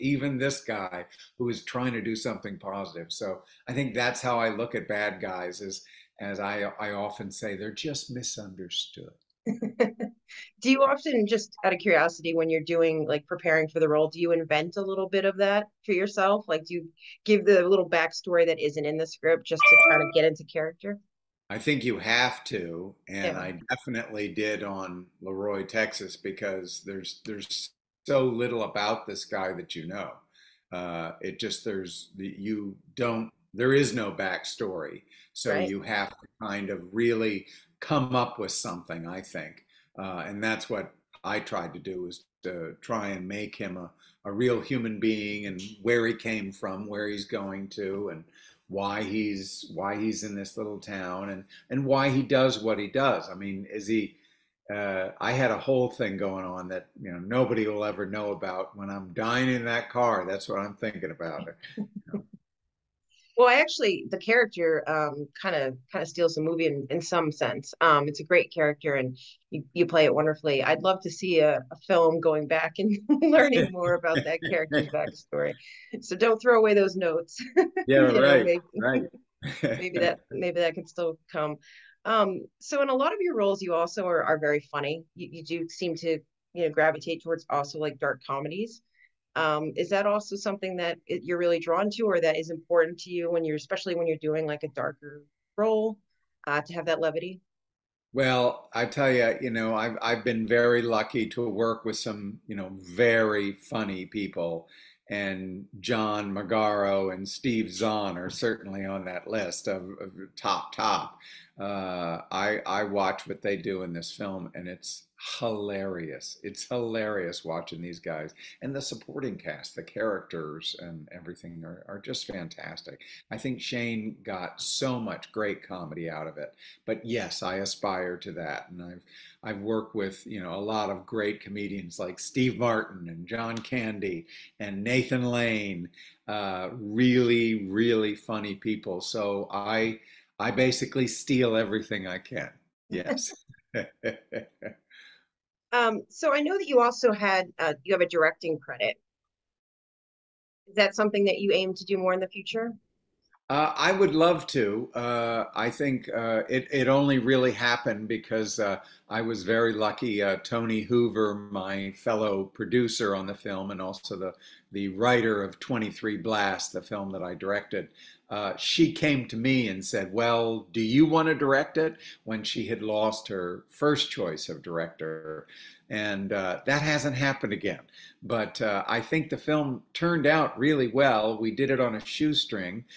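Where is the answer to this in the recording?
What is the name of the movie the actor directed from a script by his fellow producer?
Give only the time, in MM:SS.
02:45.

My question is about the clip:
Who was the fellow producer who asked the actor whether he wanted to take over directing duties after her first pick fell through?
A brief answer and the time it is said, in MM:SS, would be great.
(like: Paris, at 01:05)
Toni Hoover, at 02:40.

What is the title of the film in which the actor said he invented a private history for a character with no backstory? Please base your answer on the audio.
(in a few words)
LaRoy, Texas.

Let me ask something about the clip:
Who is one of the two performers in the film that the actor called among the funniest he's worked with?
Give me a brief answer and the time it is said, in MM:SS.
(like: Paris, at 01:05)
Steve Zahn, at 01:47.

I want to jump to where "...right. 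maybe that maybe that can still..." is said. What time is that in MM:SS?
01:18.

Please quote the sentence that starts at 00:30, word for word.
Uh, it just there's you don't there is no backstory, so right.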